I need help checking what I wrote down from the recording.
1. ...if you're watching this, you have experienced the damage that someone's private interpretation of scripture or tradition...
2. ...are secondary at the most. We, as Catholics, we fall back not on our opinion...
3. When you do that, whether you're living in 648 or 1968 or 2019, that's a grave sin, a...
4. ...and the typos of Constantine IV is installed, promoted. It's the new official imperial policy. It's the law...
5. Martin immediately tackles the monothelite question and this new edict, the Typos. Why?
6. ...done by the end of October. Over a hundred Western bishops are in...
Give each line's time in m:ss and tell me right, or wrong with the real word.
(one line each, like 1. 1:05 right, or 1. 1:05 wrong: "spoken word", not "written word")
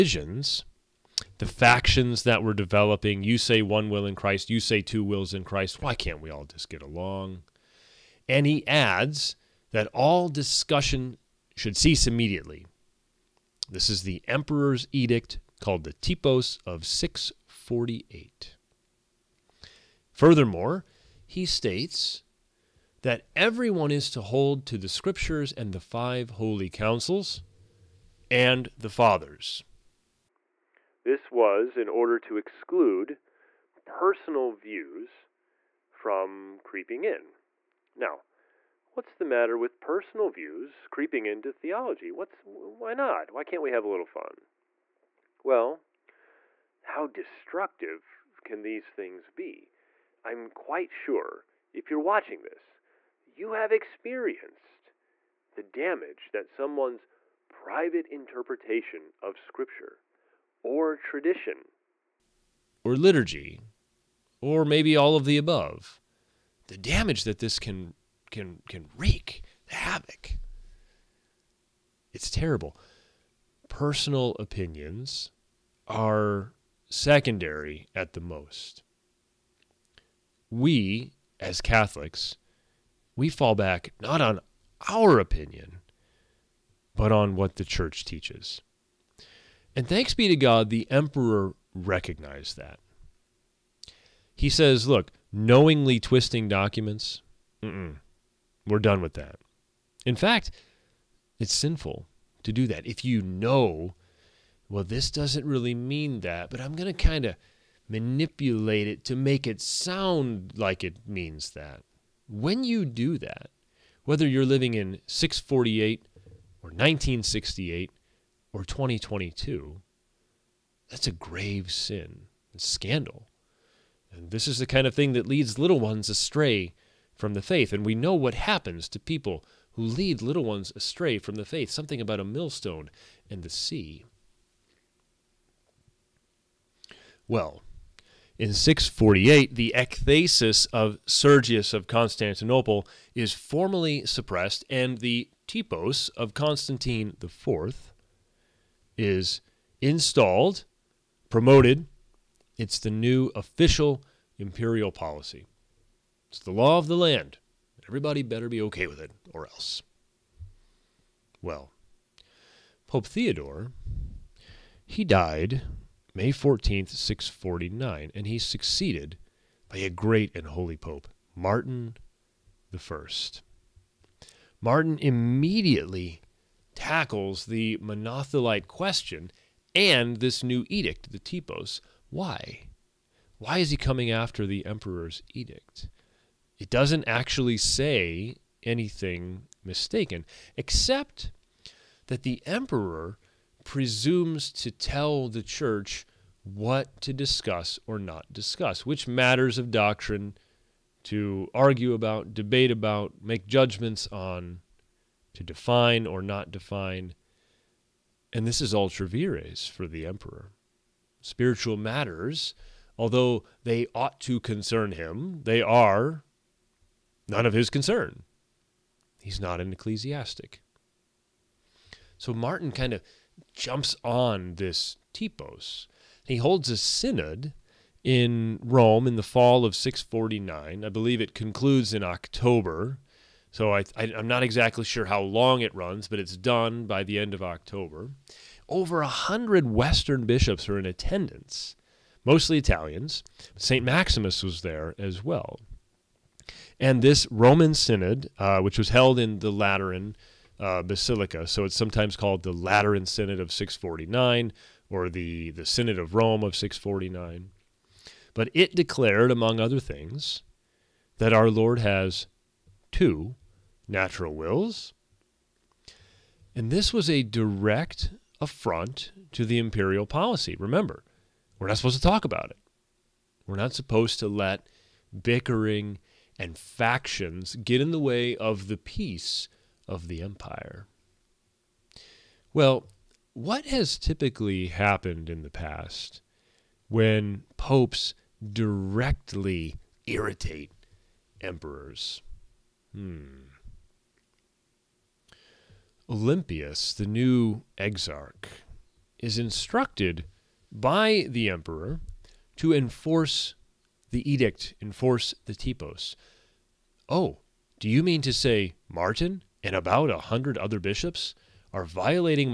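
1. 0:51 right
2. 1:15 right
3. 1:52 wrong: "2022", not "2019"
4. 2:24 right
5. 2:54 right
6. 3:56 right.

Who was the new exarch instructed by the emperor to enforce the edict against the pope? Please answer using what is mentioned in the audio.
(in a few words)
Olympius.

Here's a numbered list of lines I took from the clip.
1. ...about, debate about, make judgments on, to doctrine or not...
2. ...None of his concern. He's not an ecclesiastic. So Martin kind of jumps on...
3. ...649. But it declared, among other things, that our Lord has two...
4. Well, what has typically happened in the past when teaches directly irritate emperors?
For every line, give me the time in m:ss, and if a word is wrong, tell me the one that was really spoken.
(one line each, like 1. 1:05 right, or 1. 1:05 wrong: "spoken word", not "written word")
1. 3:21 wrong: "define", not "doctrine"
2. 3:37 right
3. 4:16 right
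4. 4:42 wrong: "popes", not "teaches".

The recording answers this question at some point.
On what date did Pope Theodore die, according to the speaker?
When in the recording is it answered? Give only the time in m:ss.
2:46.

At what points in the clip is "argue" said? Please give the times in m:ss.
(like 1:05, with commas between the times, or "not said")
3:21.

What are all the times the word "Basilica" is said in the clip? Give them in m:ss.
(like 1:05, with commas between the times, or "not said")
4:10.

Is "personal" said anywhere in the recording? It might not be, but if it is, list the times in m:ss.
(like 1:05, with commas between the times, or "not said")
0:33, 0:39, 1:13.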